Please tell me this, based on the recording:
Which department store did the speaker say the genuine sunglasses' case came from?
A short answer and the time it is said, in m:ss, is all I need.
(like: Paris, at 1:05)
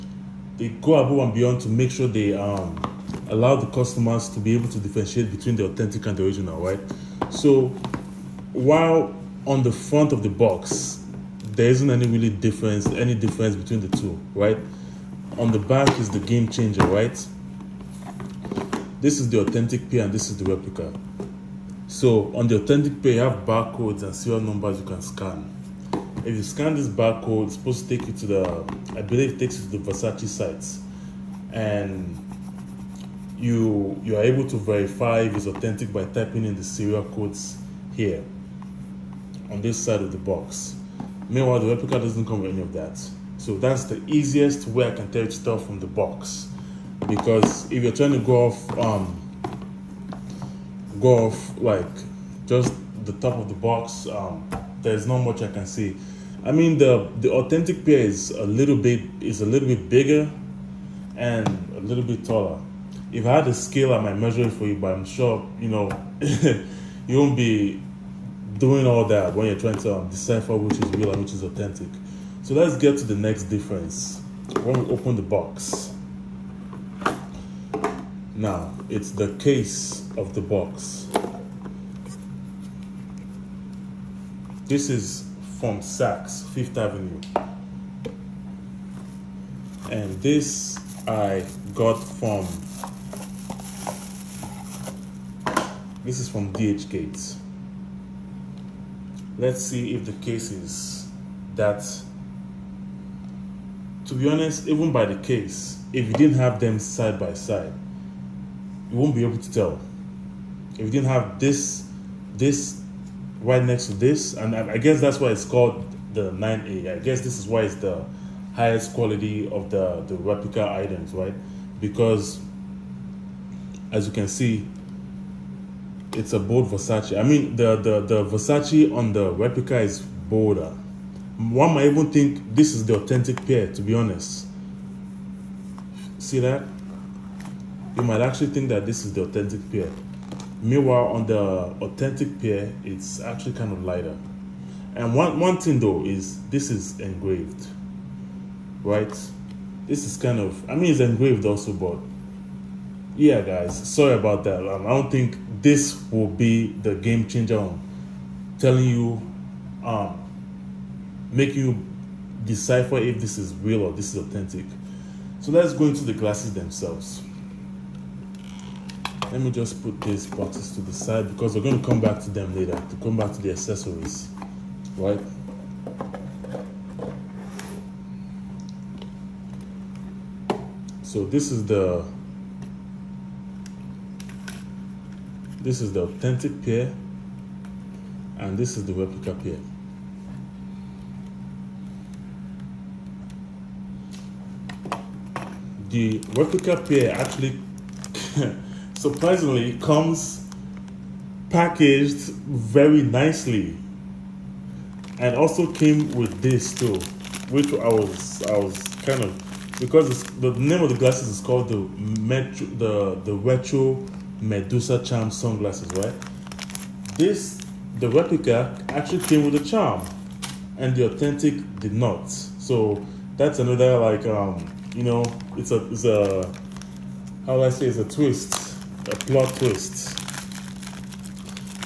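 Saks Fifth Avenue, at 1:25.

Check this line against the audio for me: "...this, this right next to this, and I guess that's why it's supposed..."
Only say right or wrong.
wrong.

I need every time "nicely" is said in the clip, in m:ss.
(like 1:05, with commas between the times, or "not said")
3:23.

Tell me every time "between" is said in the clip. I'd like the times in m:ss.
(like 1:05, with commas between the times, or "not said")
0:05, 0:13.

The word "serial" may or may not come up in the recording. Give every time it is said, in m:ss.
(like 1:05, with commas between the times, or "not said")
0:24, 0:36.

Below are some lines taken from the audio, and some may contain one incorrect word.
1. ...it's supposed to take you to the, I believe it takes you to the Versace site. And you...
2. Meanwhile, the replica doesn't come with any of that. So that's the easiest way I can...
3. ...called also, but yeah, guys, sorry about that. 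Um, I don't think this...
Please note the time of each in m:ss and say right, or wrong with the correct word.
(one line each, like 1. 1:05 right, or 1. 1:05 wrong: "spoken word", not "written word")
1. 0:27 right
2. 0:41 right
3. 2:30 wrong: "engraved", not "called".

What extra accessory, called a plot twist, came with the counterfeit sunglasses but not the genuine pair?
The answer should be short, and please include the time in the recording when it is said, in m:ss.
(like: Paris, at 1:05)
A charm, at 3:39.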